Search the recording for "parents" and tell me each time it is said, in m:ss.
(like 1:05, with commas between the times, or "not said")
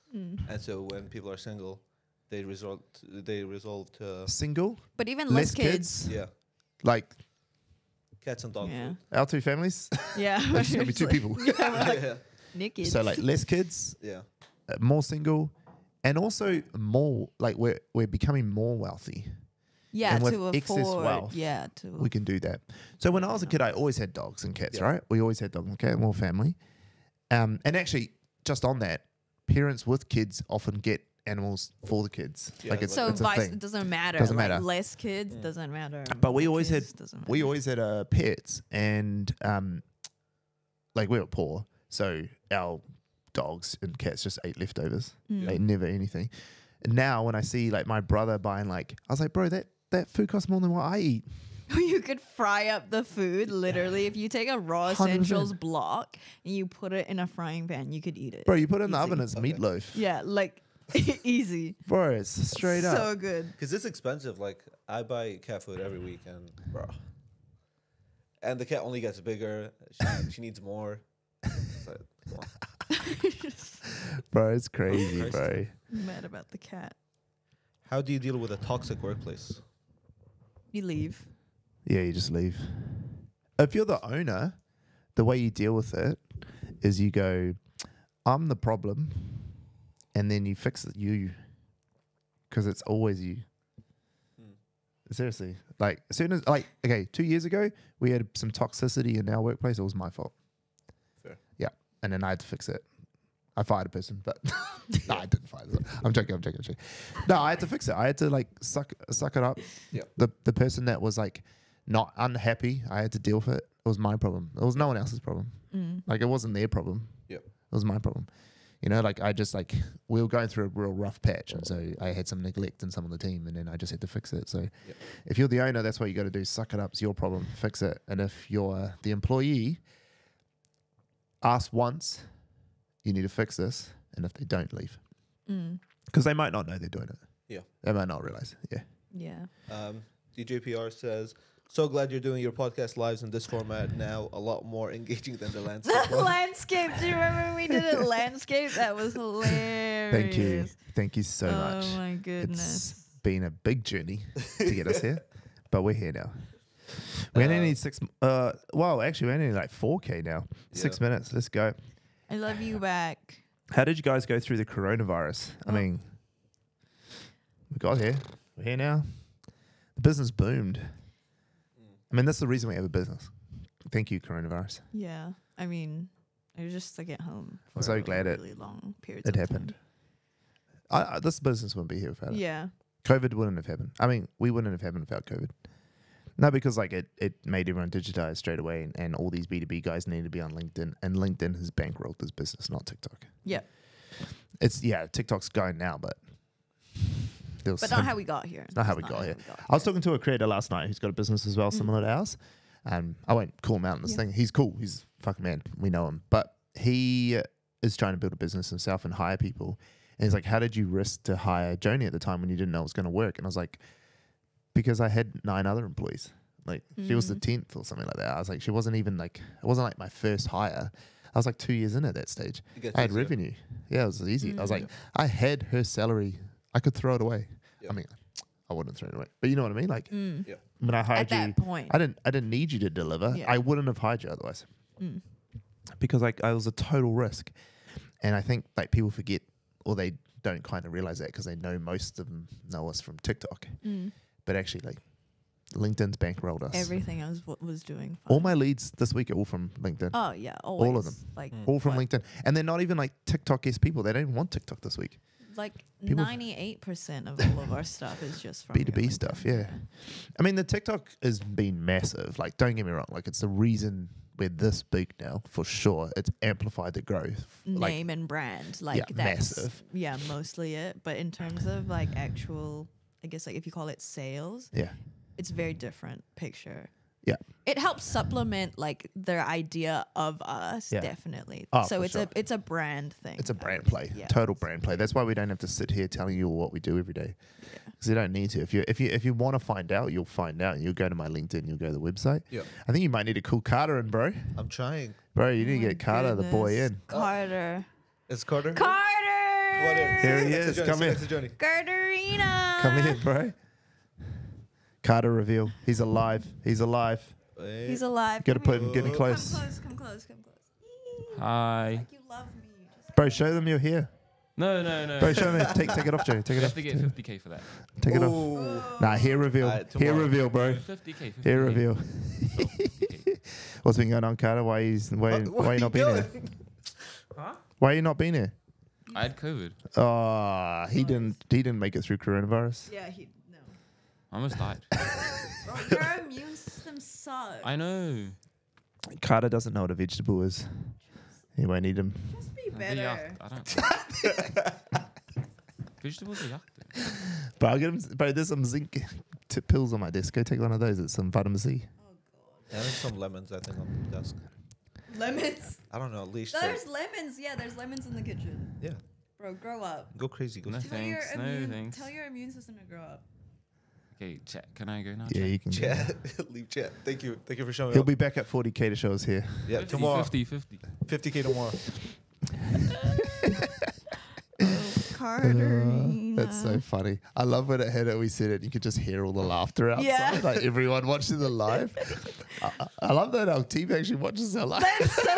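0:29.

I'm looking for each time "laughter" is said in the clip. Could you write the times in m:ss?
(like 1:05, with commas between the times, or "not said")
6:19.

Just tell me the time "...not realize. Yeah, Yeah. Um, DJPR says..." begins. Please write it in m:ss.
2:18.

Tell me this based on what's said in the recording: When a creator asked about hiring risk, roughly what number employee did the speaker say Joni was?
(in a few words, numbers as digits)
10th.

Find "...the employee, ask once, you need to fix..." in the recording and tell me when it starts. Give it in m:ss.
2:09.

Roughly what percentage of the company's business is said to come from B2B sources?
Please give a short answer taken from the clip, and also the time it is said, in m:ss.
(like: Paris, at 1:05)
98%, at 4:16.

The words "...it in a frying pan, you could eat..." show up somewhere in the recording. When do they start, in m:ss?
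0:56.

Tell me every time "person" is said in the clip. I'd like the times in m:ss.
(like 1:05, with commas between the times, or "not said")
1:43, 1:50.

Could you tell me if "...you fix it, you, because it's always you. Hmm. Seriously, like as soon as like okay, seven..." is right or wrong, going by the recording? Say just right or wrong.
wrong.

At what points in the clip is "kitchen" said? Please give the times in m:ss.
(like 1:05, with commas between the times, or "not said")
5:58.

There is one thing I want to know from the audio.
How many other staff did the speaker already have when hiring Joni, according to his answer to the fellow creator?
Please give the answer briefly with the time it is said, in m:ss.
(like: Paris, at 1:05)
9, at 3:35.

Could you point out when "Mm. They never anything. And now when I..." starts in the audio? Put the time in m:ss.
0:45.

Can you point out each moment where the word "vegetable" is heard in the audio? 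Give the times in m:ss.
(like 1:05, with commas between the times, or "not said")
5:39, 5:46.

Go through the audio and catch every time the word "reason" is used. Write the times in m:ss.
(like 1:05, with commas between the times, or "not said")
2:52, 4:23.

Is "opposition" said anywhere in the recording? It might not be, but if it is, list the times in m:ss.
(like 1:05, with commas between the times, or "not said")
not said.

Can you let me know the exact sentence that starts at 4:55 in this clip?
You need oh to get Carter goodness.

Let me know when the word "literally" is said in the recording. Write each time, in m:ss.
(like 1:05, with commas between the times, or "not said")
0:53.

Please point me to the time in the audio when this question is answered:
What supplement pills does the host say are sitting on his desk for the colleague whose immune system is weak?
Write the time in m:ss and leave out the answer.
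5:48.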